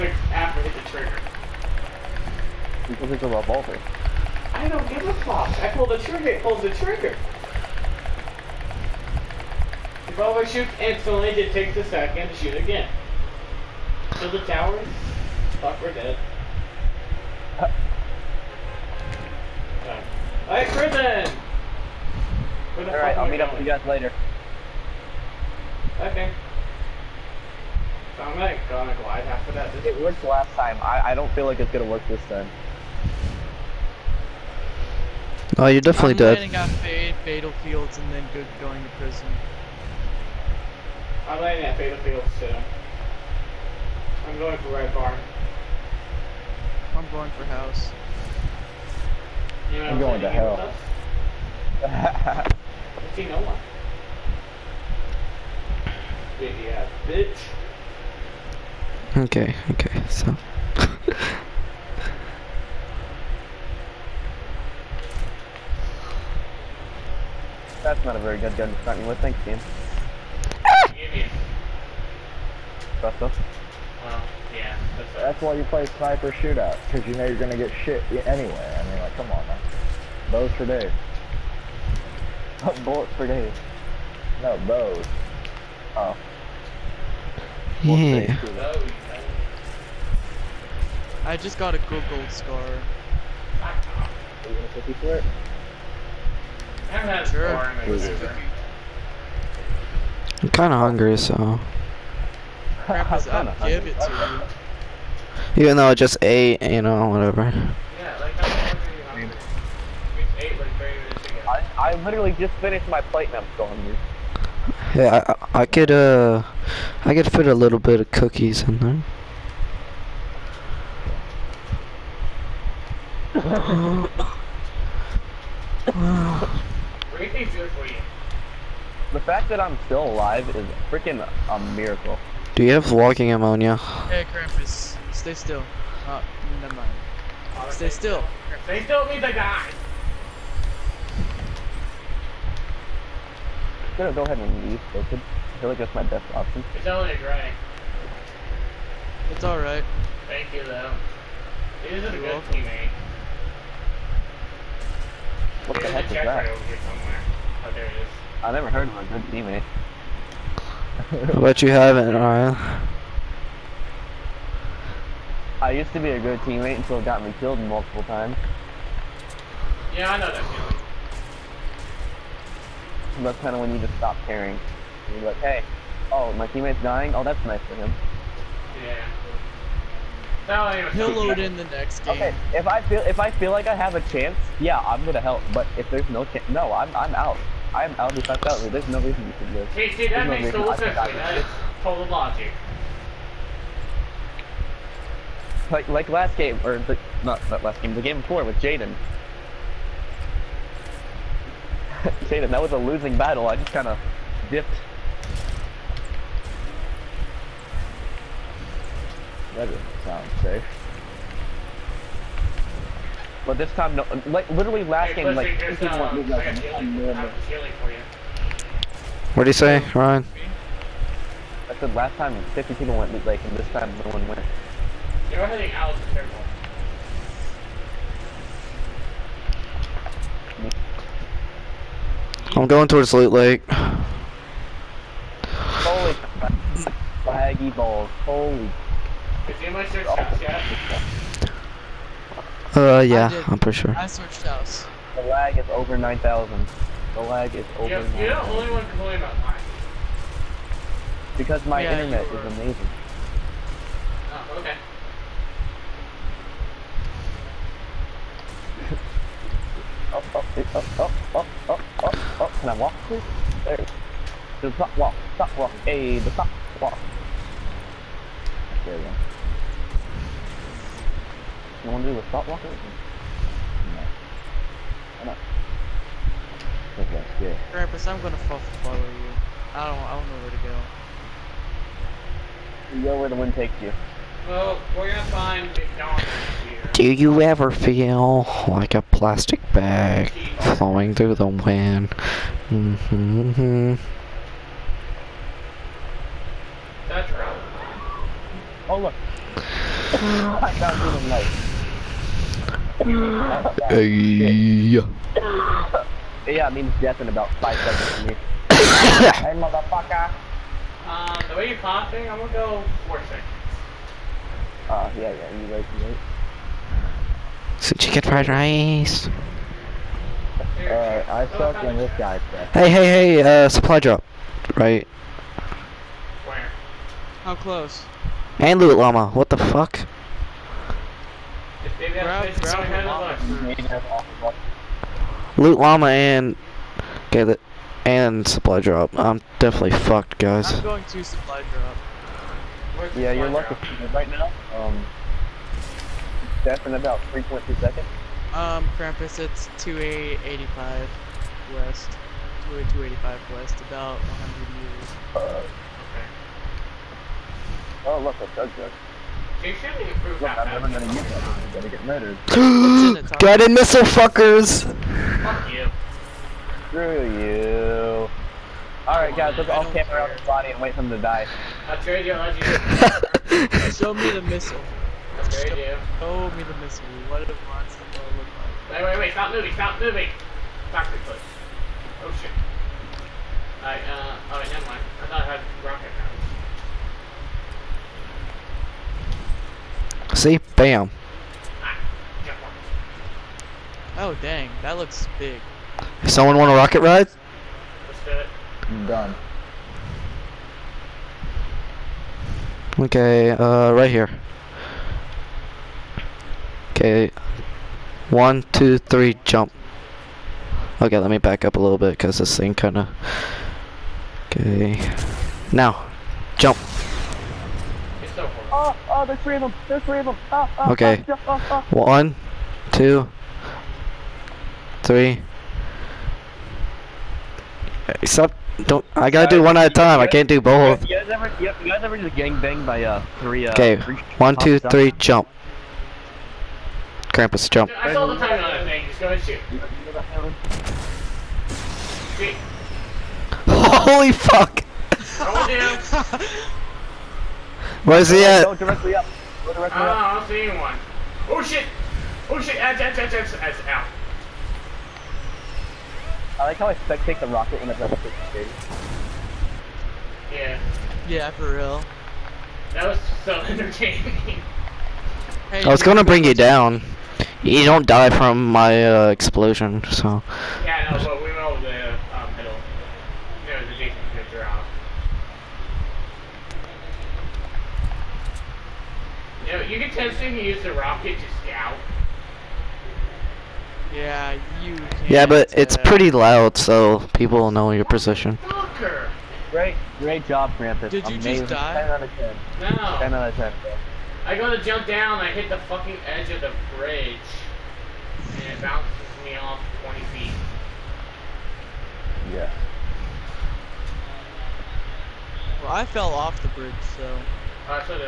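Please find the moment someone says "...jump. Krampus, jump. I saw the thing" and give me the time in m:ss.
7:15.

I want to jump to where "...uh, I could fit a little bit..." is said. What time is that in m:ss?
1:55.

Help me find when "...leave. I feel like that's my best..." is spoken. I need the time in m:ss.
2:24.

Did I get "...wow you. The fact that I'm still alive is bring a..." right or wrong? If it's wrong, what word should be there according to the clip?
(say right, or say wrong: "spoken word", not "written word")
wrong: "freaking", not "bring".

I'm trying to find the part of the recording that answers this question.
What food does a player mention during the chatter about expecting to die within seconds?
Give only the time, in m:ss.
5:17.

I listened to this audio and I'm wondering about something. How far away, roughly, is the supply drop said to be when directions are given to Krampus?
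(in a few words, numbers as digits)
100 meters.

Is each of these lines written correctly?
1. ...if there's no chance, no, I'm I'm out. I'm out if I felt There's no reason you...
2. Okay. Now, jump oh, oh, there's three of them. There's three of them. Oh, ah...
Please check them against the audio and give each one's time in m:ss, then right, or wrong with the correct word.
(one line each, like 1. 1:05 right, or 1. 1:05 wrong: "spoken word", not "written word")
1. 3:05 right
2. 6:54 right.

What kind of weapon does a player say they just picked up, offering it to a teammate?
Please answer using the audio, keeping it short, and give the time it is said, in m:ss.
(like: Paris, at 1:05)
gold scar, at 1:32.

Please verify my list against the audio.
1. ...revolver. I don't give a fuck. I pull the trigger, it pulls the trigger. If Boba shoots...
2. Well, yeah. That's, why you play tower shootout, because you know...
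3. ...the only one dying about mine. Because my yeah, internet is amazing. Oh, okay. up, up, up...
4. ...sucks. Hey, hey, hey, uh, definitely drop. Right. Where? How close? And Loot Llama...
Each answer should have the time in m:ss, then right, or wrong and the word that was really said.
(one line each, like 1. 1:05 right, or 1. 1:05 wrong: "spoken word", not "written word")
1. 0:03 right
2. 1:13 wrong: "sniper", not "tower"
3. 4:08 wrong: "complaining", not "dying"
4. 5:22 wrong: "supply", not "definitely".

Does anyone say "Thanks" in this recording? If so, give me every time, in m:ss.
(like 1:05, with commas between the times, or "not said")
1:09, 2:30.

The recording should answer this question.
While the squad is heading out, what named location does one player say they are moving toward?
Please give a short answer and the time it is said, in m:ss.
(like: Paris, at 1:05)
Loot Lake, at 3:53.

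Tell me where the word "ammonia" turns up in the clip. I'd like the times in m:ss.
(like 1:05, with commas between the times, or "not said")
2:13.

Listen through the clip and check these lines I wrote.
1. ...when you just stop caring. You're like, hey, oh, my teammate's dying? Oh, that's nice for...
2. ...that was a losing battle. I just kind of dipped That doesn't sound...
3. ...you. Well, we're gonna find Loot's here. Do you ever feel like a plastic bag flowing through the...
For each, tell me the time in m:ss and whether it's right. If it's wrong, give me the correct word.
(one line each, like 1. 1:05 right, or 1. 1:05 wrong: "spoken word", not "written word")
1. 2:53 right
2. 3:22 right
3. 4:43 wrong: "McDonald", not "Loot".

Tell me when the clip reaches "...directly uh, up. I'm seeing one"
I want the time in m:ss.
7:29.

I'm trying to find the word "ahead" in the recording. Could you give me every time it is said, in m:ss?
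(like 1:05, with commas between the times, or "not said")
2:24.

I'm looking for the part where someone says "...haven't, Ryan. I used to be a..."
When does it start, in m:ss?
2:41.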